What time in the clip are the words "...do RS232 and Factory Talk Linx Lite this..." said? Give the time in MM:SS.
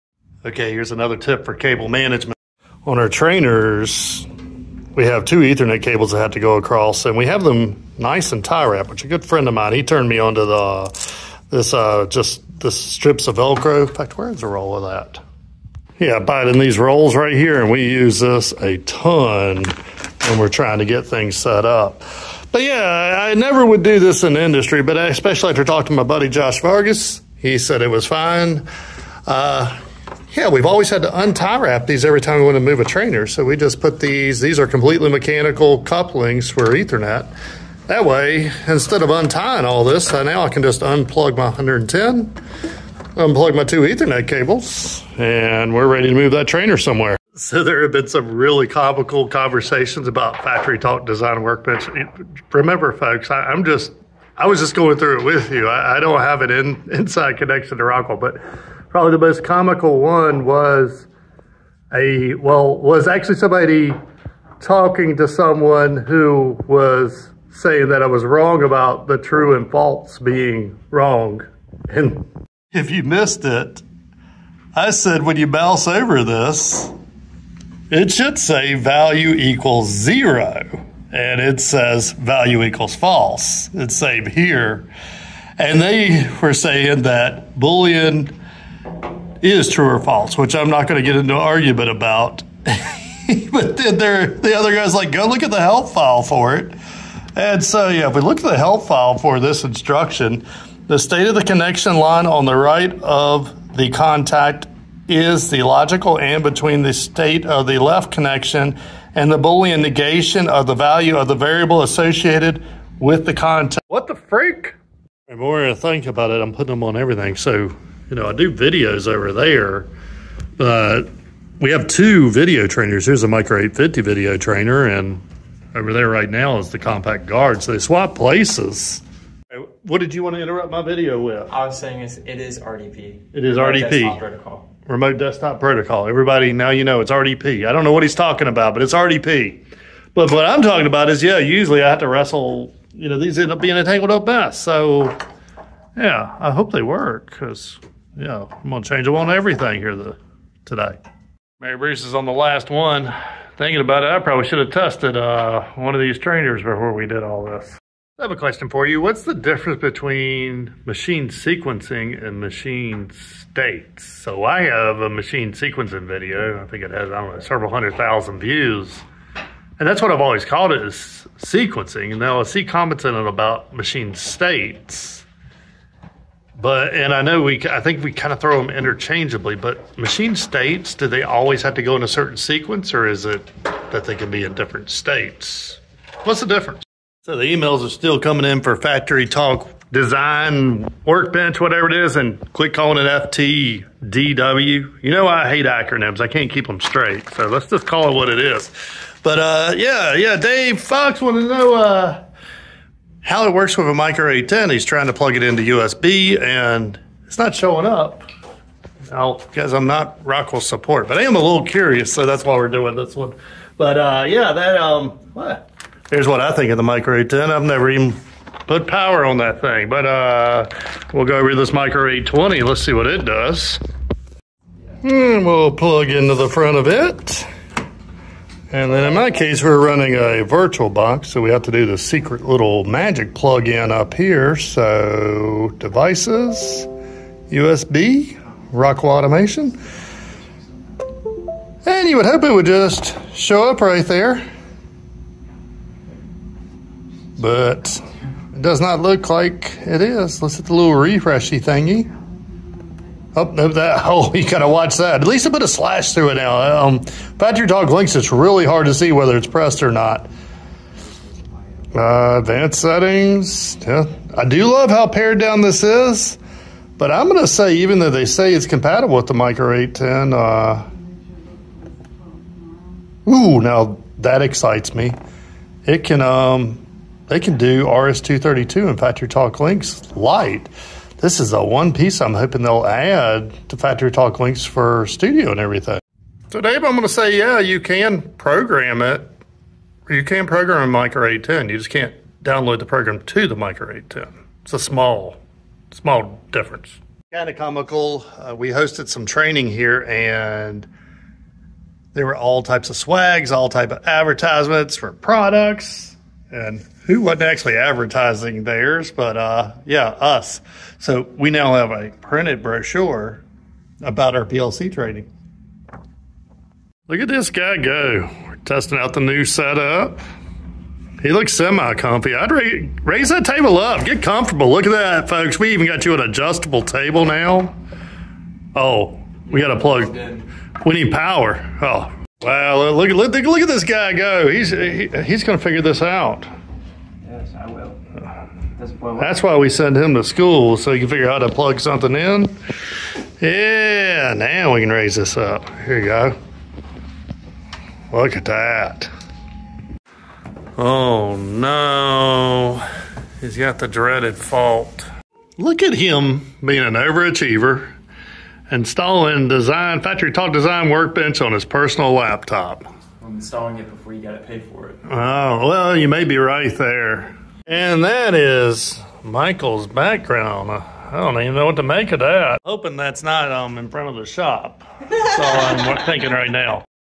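04:37.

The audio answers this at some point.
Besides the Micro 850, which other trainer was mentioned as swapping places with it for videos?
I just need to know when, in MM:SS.
02:06.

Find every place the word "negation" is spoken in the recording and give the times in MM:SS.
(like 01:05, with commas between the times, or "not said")
01:49.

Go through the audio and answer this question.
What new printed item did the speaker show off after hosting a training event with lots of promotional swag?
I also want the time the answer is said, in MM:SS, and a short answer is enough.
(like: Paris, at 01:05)
brochure, at 05:12.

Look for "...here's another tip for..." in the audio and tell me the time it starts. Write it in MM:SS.
00:00.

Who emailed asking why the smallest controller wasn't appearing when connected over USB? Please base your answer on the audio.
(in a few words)
Dave Fox.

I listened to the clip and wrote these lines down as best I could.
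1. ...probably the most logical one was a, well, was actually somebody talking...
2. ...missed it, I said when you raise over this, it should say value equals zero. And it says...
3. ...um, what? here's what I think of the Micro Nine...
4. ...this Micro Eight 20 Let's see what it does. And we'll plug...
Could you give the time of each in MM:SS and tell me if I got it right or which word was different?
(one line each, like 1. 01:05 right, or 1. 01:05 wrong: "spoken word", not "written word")
1. 00:58 wrong: "comical", not "logical"
2. 01:13 wrong: "mouse", not "raise"
3. 03:34 wrong: "Eight", not "Nine"
4. 03:41 right.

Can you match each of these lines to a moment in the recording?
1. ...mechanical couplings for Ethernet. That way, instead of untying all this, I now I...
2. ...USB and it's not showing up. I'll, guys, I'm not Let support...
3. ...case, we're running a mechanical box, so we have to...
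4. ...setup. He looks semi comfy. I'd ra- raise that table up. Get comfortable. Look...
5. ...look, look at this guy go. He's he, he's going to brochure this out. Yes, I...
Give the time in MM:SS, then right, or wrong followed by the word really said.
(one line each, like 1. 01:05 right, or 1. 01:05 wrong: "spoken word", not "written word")
1. 00:35 right
2. 03:25 wrong: "Rockwell", not "Let"
3. 03:49 wrong: "virtual", not "mechanical"
4. 05:19 right
5. 05:33 wrong: "figure", not "brochure".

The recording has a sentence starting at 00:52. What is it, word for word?
Remember, folks, I, am just, I was just going through it with you.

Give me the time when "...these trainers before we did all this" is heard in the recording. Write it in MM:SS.
02:36.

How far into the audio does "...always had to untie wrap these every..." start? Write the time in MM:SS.
00:30.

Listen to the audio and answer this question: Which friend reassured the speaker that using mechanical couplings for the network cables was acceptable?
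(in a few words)
Josh Vargas.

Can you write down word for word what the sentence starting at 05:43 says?
Yeah, now we can raise this up.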